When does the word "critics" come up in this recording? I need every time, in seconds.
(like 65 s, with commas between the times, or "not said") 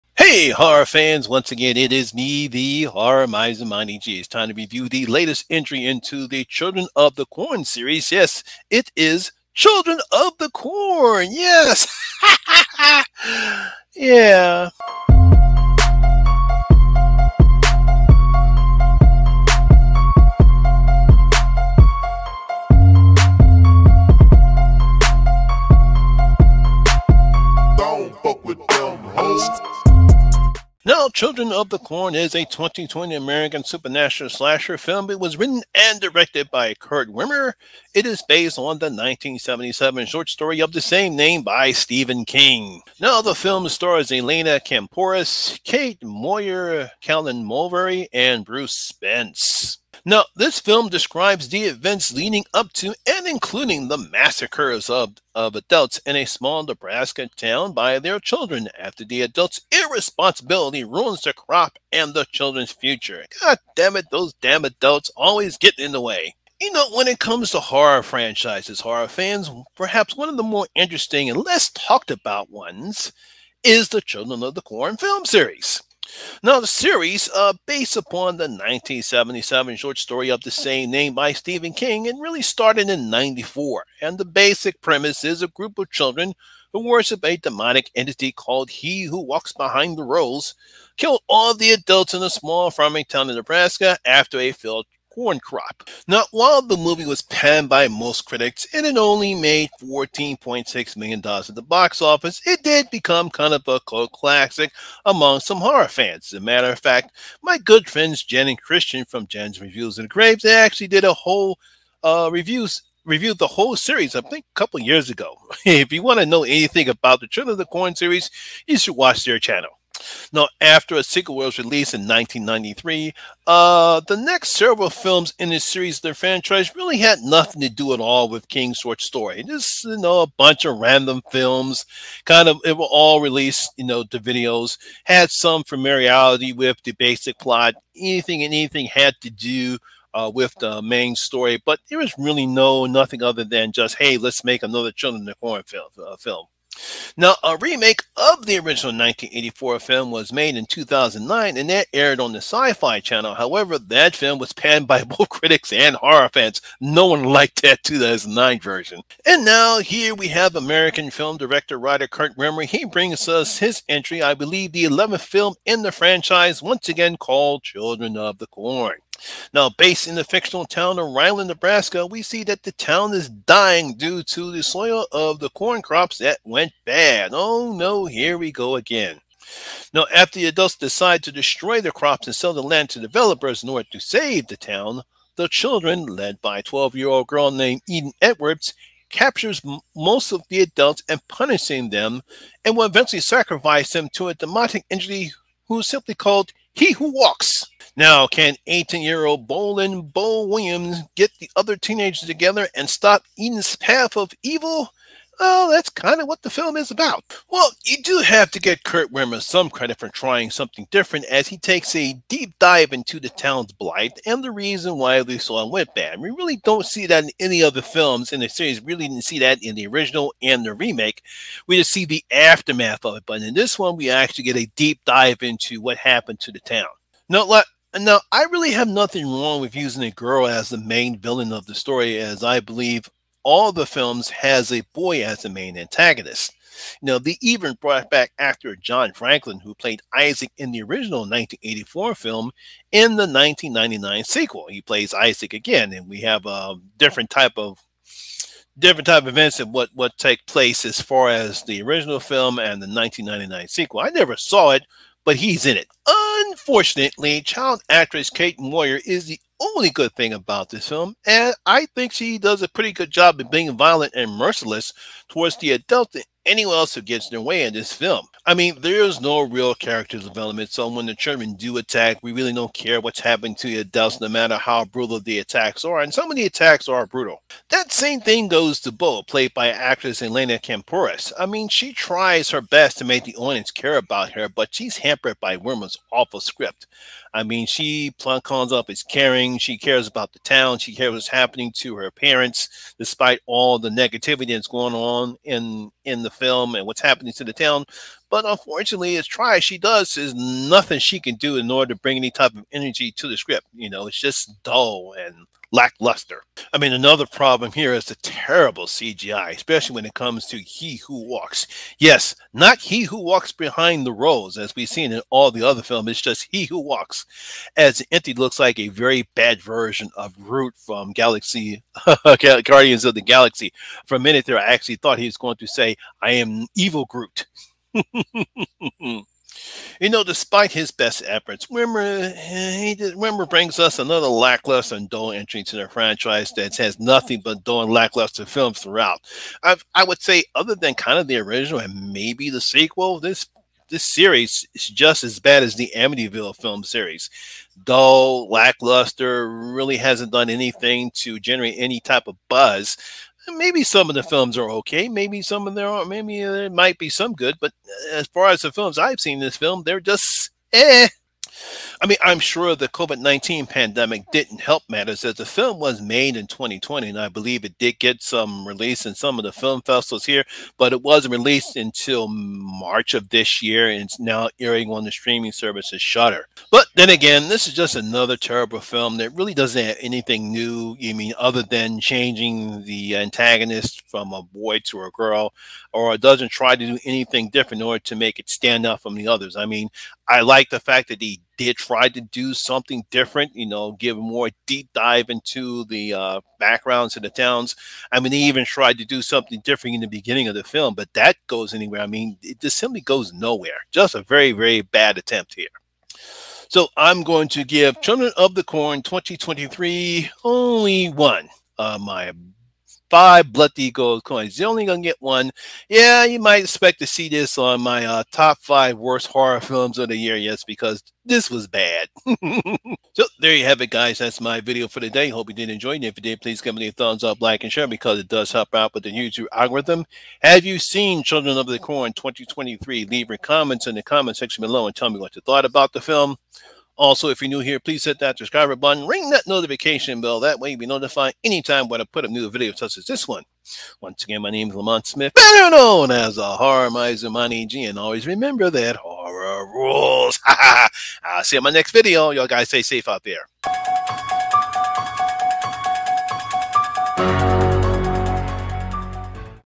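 98 s, 155 s.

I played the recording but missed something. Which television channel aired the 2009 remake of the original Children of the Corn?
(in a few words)
Sci Fi Channel.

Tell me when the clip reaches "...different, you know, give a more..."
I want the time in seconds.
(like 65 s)
393 s.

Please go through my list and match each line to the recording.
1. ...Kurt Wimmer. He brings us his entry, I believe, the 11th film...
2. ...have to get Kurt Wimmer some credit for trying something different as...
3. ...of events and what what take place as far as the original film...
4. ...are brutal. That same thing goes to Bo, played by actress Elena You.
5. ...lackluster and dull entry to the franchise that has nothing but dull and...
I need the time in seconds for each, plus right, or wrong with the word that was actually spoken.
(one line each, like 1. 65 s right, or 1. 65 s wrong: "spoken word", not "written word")
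1. 162 s right
2. 208 s right
3. 249 s right
4. 276 s wrong: "Kampouris", not "You"
5. 334 s right.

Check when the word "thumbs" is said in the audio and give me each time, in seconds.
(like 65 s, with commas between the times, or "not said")
426 s.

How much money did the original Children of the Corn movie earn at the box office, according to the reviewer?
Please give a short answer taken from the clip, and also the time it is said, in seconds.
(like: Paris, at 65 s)
$14.6 million, at 99 s.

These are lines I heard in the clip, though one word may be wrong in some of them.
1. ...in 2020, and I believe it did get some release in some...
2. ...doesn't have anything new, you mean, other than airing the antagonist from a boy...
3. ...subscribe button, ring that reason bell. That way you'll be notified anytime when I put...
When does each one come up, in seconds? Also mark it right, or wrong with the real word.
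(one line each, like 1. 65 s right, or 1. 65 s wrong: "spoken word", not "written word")
1. 366 s right
2. 379 s wrong: "changing", not "airing"
3. 438 s wrong: "notification", not "reason".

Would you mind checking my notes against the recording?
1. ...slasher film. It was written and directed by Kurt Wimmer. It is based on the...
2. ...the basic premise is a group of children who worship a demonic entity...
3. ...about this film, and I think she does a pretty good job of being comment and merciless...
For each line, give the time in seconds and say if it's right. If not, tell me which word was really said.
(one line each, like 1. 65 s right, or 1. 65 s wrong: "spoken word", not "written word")
1. 34 s right
2. 84 s right
3. 260 s wrong: "violent", not "comment".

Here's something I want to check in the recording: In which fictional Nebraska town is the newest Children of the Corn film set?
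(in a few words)
Ryland.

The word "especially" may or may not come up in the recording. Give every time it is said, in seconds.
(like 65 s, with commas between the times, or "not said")
309 s.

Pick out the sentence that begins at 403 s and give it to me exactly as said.
Just a very, very bad attempt here.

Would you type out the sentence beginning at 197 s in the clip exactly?
Now, can 18 year old Boleyn Bo Williams get the other teenagers together and stop Eden's path of evil?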